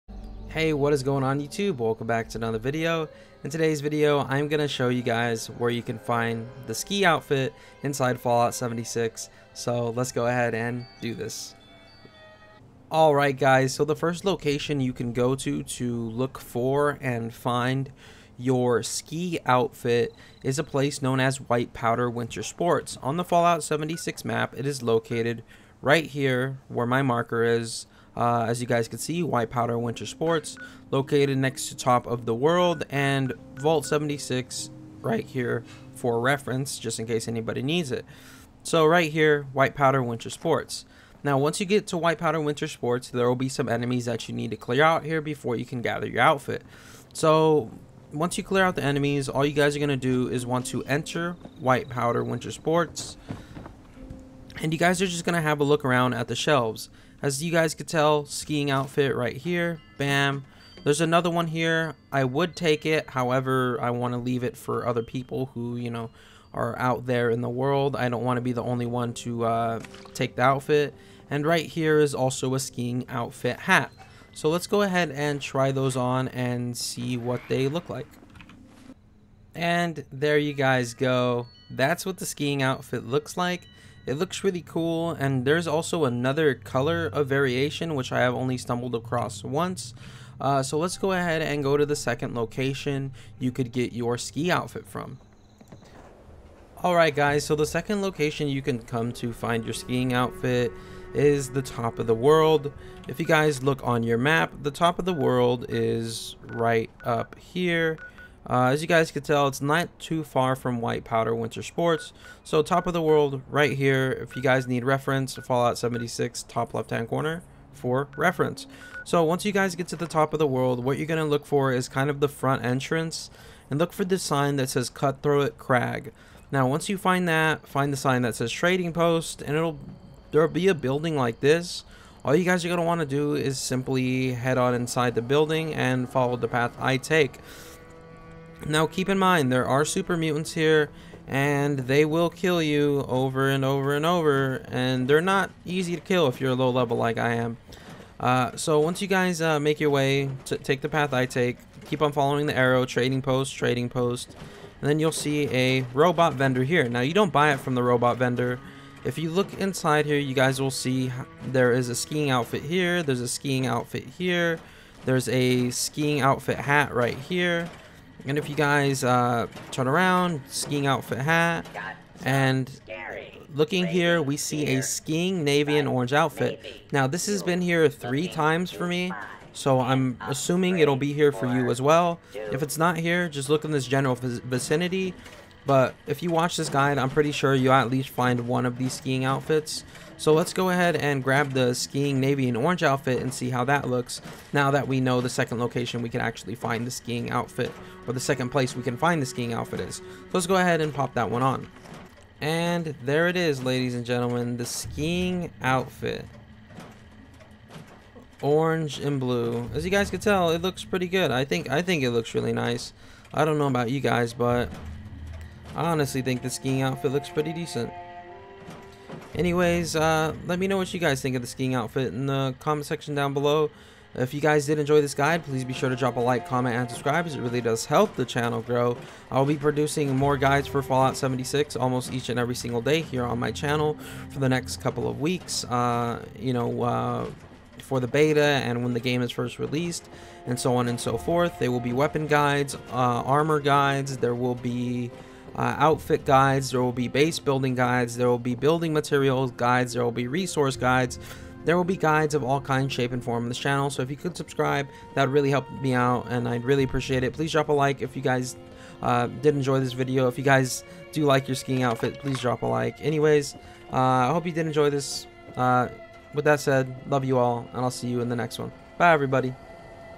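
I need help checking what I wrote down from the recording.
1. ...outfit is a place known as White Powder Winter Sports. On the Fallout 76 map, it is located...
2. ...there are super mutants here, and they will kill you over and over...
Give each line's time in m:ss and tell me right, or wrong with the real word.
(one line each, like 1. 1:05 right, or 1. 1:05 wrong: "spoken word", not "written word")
1. 0:19 right
2. 2:19 right.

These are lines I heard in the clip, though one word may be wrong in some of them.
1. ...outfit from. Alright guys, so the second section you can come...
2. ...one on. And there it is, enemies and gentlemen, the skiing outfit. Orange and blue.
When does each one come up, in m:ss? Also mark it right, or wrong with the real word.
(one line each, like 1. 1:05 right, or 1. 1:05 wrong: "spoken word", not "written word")
1. 1:34 wrong: "location", not "section"
2. 3:21 wrong: "ladies", not "enemies".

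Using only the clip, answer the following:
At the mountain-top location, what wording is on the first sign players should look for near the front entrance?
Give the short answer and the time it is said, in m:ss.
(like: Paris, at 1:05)
Cutthroat Crag, at 2:04.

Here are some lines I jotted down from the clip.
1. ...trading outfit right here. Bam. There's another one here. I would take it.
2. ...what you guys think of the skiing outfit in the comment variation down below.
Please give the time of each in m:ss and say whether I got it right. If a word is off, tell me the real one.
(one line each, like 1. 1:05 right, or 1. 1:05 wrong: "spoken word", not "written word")
1. 0:58 wrong: "skiing", not "trading"
2. 3:40 wrong: "section", not "variation".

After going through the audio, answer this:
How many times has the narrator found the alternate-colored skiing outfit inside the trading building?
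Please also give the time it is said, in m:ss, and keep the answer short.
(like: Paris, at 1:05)
3, at 2:57.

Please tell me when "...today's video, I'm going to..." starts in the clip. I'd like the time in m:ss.
0:03.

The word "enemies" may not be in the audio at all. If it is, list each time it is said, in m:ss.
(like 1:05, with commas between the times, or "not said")
0:43, 0:48.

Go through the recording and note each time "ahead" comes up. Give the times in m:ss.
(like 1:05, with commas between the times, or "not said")
0:10, 1:14, 1:31, 3:10, 3:20.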